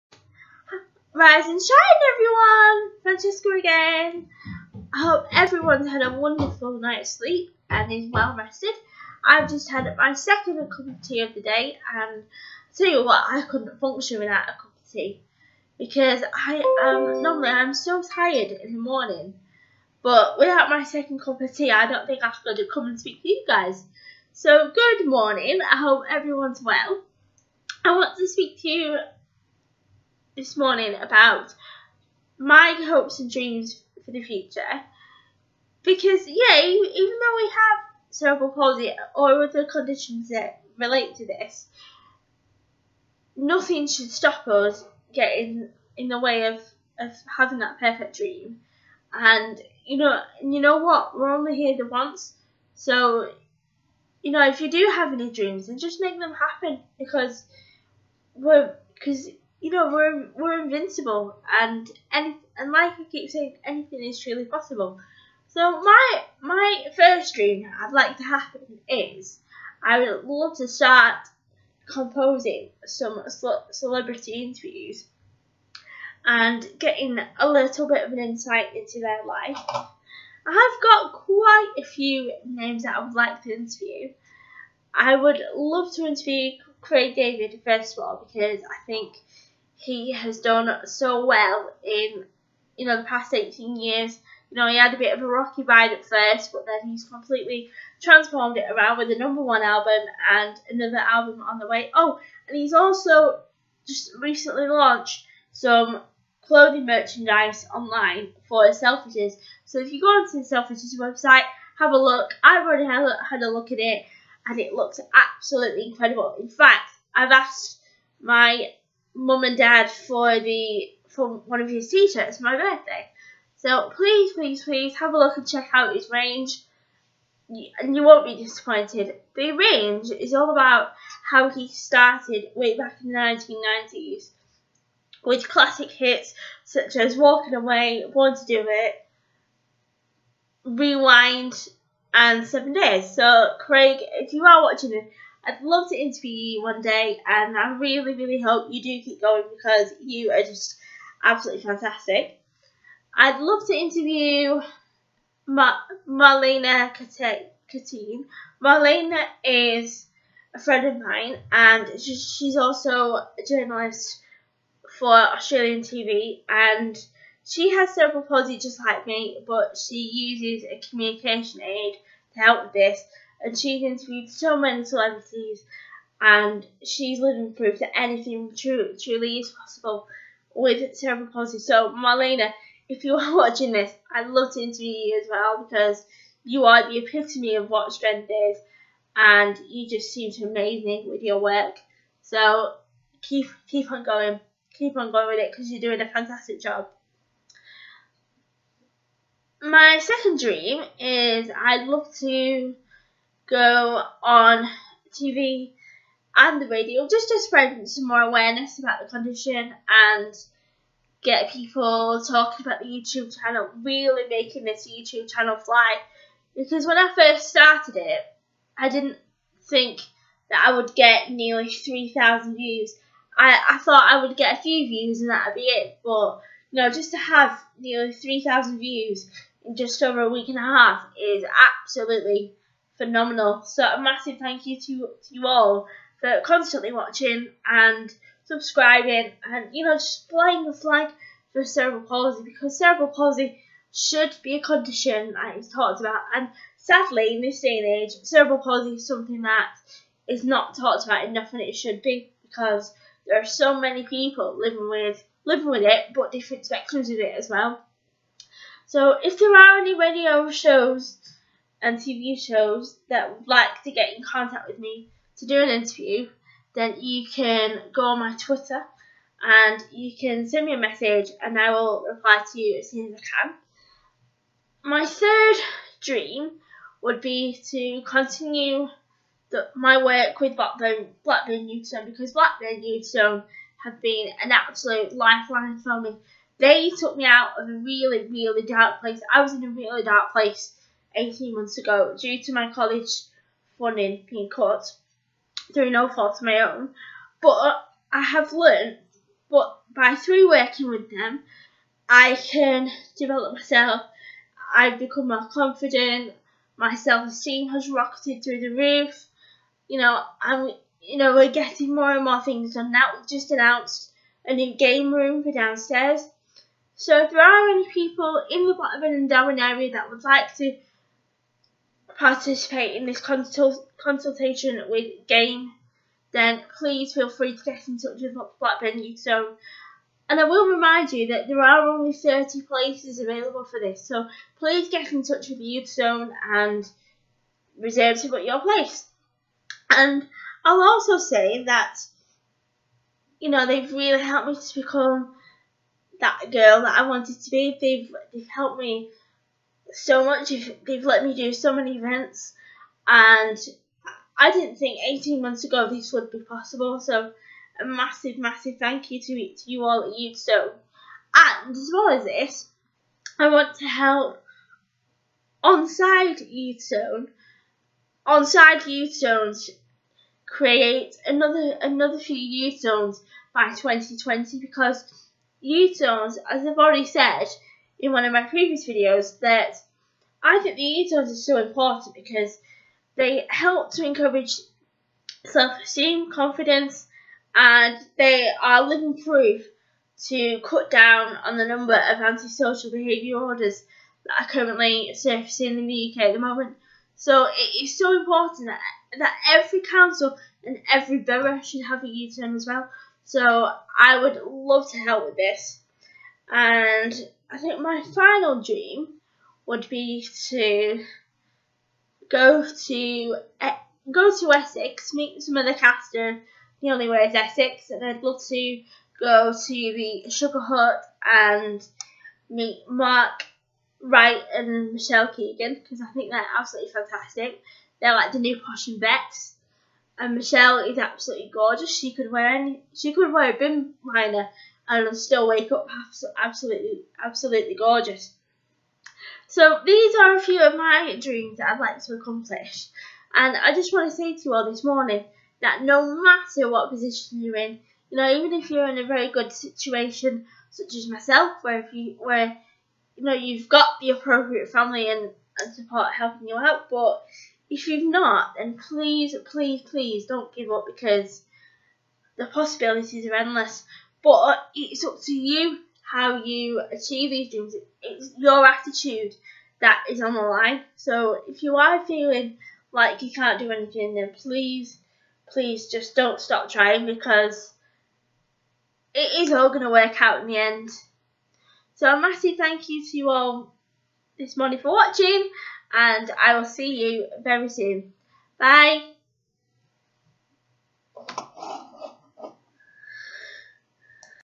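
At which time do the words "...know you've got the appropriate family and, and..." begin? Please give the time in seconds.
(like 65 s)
453 s.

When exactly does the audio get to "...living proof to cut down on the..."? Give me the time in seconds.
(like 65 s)
388 s.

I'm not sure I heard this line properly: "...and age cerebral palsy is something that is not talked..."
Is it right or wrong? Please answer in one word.
right.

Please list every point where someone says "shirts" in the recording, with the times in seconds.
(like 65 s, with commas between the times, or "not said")
121 s.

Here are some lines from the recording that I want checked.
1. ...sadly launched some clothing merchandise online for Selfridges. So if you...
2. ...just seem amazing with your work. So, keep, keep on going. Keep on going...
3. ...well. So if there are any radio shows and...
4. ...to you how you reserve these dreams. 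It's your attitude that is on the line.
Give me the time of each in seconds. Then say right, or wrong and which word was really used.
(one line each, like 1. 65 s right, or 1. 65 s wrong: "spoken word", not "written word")
1. 104 s wrong: "recently", not "sadly"
2. 189 s right
3. 257 s right
4. 465 s wrong: "achieve", not "reserve".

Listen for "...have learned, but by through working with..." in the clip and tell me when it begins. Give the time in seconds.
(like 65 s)
298 s.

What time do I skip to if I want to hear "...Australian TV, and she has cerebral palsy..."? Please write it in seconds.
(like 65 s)
165 s.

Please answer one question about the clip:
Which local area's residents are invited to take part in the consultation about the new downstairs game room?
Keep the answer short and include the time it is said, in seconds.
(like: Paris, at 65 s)
Blackburn and Darwen, at 318 s.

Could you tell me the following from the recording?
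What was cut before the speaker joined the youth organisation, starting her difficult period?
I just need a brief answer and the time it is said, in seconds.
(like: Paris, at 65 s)
College funding, at 292 s.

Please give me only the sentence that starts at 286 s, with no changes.
They took me out of a really, really dark place.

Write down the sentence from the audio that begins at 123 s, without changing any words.
So please, please, please have a look and check out his range, and you won't be disappointed.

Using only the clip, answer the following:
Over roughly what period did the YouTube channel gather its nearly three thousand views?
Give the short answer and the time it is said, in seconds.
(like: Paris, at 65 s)
Just over a week and a half, at 229 s.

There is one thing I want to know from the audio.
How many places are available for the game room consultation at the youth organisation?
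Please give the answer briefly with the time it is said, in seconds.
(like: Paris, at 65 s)
30, at 332 s.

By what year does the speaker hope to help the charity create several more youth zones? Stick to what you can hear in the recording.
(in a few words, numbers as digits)
2020.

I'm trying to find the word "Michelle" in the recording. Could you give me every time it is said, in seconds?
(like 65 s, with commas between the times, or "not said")
424 s, 430 s.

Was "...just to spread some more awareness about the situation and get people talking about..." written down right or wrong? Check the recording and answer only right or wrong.
wrong.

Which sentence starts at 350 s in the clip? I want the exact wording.
They've let me do so many events, and I didn't think 18 months ago this would be possible.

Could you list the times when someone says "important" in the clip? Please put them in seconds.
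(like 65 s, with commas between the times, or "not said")
381 s, 398 s.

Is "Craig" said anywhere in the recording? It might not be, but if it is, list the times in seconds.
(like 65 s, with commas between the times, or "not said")
86 s, 143 s.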